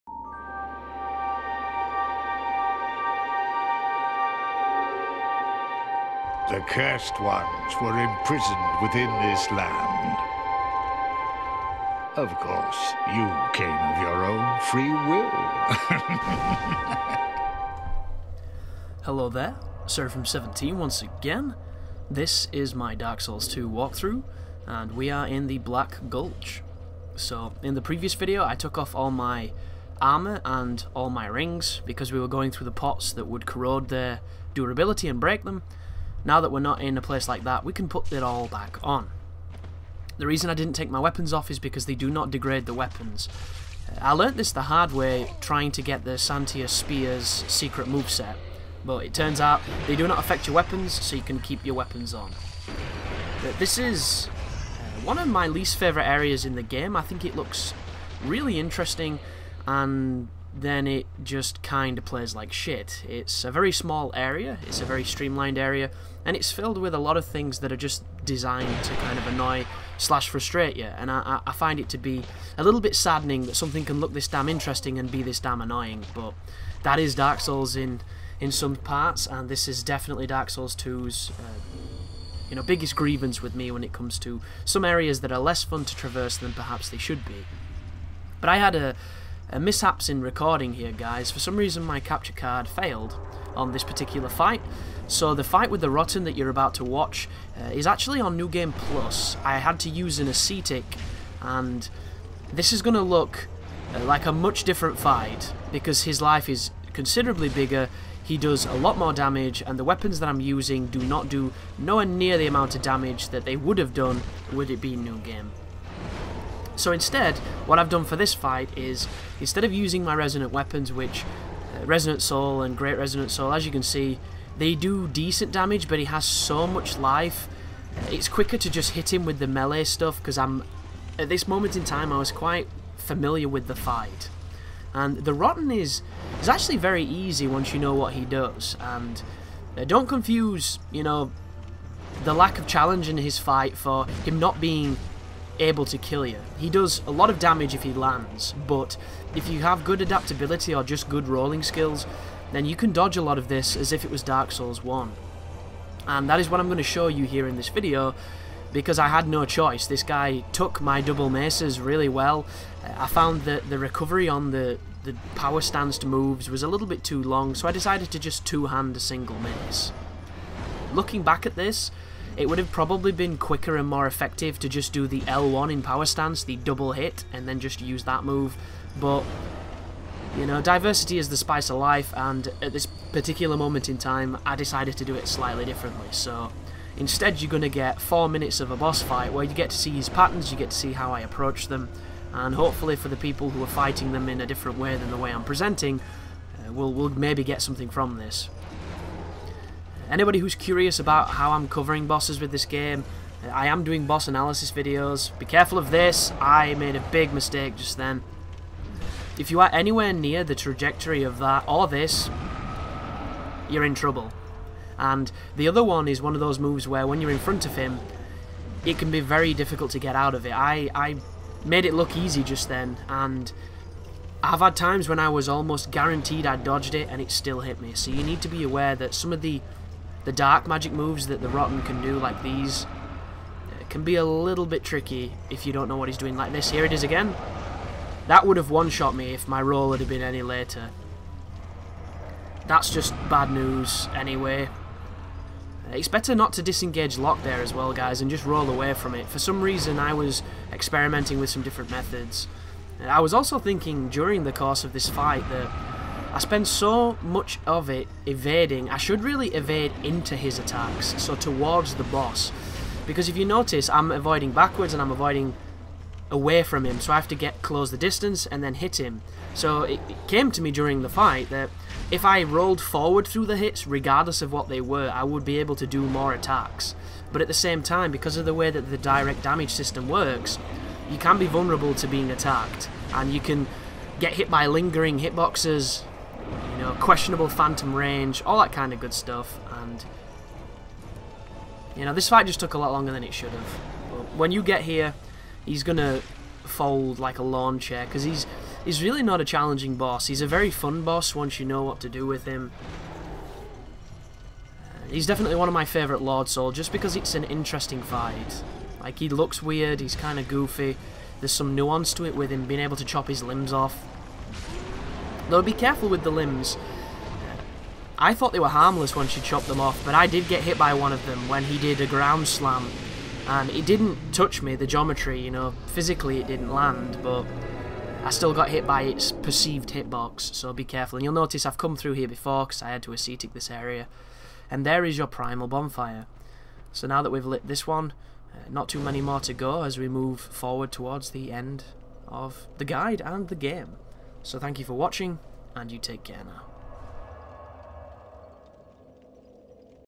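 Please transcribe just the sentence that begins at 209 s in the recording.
If you are anywhere near the trajectory of that or this, you're in trouble.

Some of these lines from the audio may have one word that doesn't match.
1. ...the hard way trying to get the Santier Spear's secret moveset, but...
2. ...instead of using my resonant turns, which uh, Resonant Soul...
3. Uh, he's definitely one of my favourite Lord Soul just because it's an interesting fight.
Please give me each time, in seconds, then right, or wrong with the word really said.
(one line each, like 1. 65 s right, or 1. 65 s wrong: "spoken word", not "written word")
1. 44 s right
2. 119 s wrong: "weapons", not "turns"
3. 304 s right.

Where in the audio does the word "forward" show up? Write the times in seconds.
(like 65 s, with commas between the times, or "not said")
272 s, 340 s.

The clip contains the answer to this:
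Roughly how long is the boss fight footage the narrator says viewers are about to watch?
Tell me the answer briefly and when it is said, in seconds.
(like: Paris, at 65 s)
4 minutes, at 188 s.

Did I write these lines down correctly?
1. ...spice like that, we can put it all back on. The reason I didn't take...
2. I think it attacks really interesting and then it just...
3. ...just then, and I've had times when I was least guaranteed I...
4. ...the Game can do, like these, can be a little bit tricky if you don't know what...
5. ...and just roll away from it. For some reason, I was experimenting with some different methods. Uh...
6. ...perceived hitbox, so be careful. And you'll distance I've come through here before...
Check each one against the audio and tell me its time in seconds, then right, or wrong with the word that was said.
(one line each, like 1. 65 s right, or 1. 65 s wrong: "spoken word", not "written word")
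1. 37 s wrong: "place", not "spice"
2. 56 s wrong: "looks", not "attacks"
3. 222 s wrong: "almost", not "least"
4. 231 s wrong: "Rotten", not "Game"
5. 248 s right
6. 329 s wrong: "notice", not "distance".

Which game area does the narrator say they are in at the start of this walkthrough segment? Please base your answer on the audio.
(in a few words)
Black Gulch.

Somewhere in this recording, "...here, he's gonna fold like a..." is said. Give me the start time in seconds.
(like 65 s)
294 s.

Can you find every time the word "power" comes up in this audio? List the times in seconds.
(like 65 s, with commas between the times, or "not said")
165 s, 175 s.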